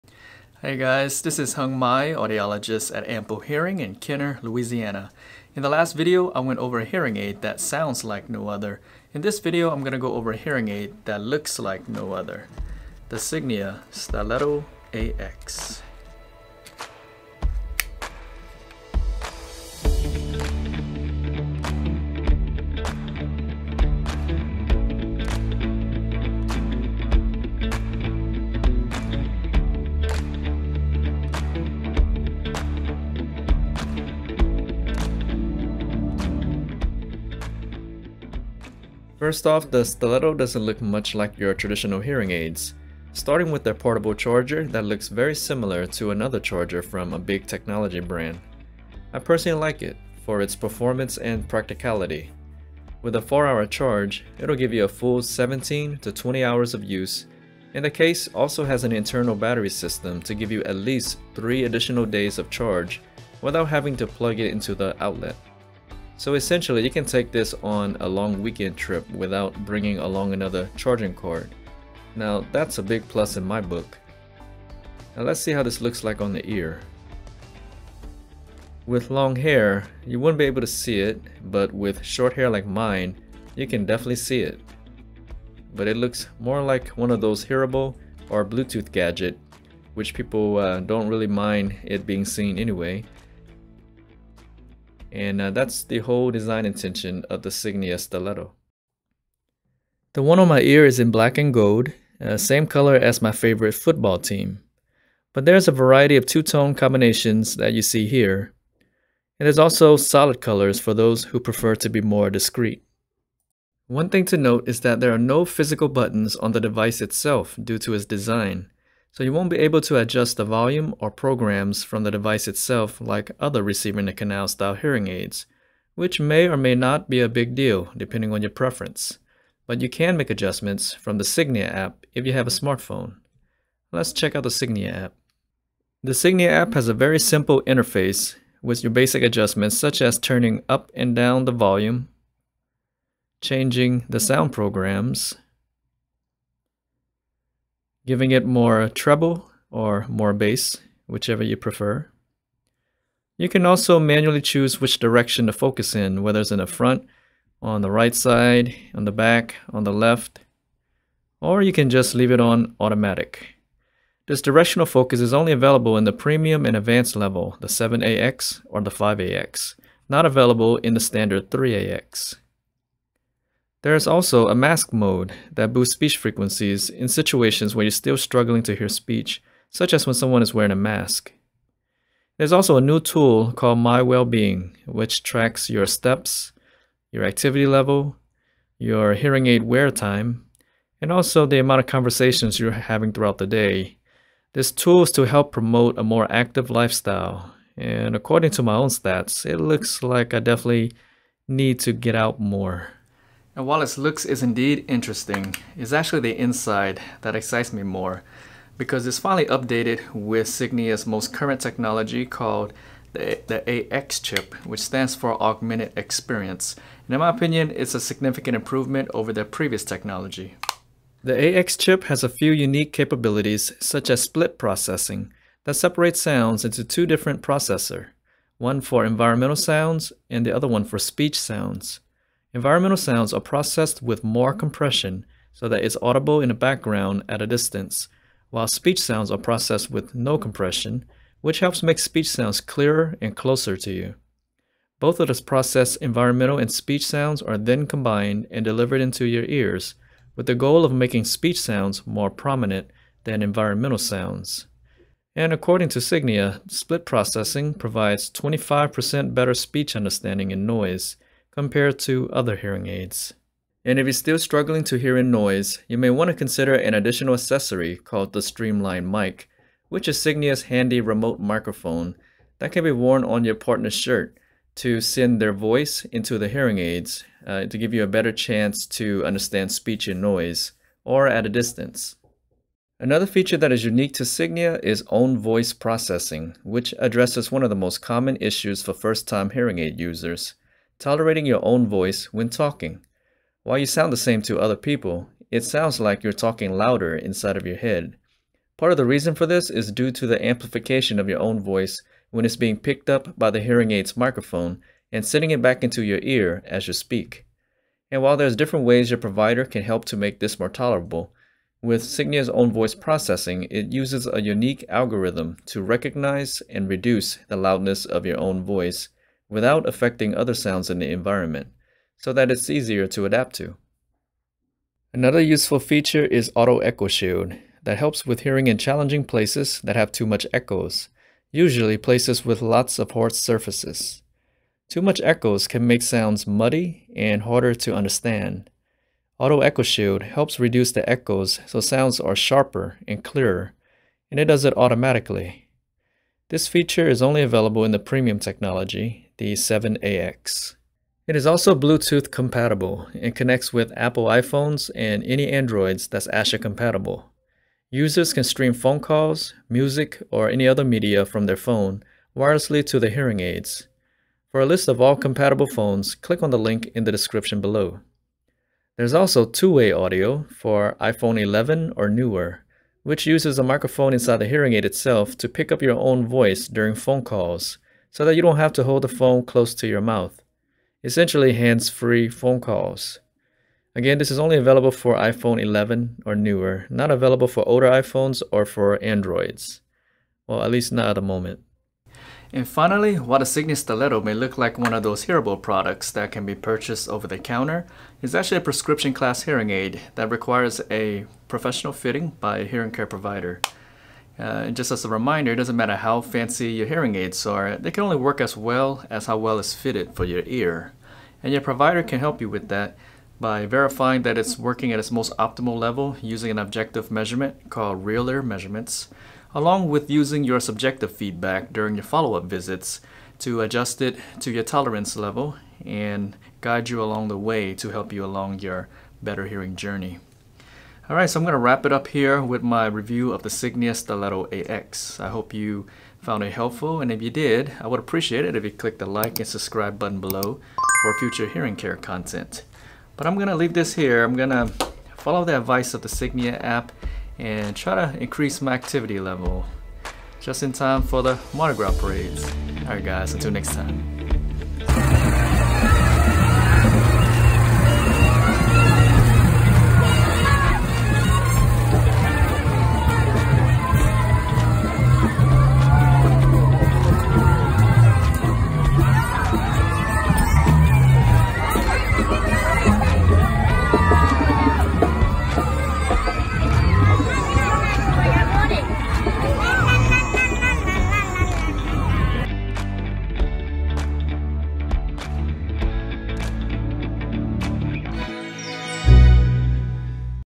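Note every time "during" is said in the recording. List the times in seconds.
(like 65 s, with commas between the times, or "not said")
376 s, 421 s.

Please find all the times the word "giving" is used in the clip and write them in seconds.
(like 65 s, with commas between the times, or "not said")
148 s.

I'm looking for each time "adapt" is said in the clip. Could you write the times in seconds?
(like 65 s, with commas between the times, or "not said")
323 s.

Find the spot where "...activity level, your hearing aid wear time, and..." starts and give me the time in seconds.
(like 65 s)
187 s.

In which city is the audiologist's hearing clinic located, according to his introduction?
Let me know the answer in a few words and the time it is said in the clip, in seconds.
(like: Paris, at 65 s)
Kenner, Louisiana, at 3 s.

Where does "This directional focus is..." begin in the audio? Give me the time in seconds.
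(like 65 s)
164 s.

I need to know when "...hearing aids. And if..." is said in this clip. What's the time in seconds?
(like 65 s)
262 s.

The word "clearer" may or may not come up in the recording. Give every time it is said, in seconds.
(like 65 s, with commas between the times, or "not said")
242 s, 343 s.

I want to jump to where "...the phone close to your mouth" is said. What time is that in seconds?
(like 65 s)
379 s.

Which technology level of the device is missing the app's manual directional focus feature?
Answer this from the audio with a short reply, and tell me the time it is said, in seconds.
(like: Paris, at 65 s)
3AX, at 171 s.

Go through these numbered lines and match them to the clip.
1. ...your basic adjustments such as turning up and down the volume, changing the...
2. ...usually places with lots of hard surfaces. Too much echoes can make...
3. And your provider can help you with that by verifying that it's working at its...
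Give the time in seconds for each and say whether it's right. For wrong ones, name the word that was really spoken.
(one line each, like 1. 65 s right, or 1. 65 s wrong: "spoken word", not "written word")
1. 138 s right
2. 331 s right
3. 411 s right.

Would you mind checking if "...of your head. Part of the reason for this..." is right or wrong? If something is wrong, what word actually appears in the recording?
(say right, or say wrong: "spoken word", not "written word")
right.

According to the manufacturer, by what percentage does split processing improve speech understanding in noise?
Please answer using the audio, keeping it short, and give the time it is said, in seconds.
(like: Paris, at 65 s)
25%, at 258 s.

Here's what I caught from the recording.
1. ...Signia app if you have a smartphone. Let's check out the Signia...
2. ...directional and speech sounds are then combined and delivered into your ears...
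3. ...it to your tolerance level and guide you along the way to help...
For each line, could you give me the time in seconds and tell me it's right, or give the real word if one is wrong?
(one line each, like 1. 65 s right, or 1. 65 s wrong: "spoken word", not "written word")
1. 131 s right
2. 246 s wrong: "environmental", not "directional"
3. 424 s right.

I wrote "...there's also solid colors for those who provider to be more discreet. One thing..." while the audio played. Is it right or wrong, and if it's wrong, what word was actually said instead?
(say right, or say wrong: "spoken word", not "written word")
wrong: "prefer", not "provider".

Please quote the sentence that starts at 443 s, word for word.
But I'm going to leave this here.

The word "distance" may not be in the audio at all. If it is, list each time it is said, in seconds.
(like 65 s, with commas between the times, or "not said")
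237 s, 281 s.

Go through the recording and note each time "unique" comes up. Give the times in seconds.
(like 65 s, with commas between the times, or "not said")
222 s, 283 s, 314 s.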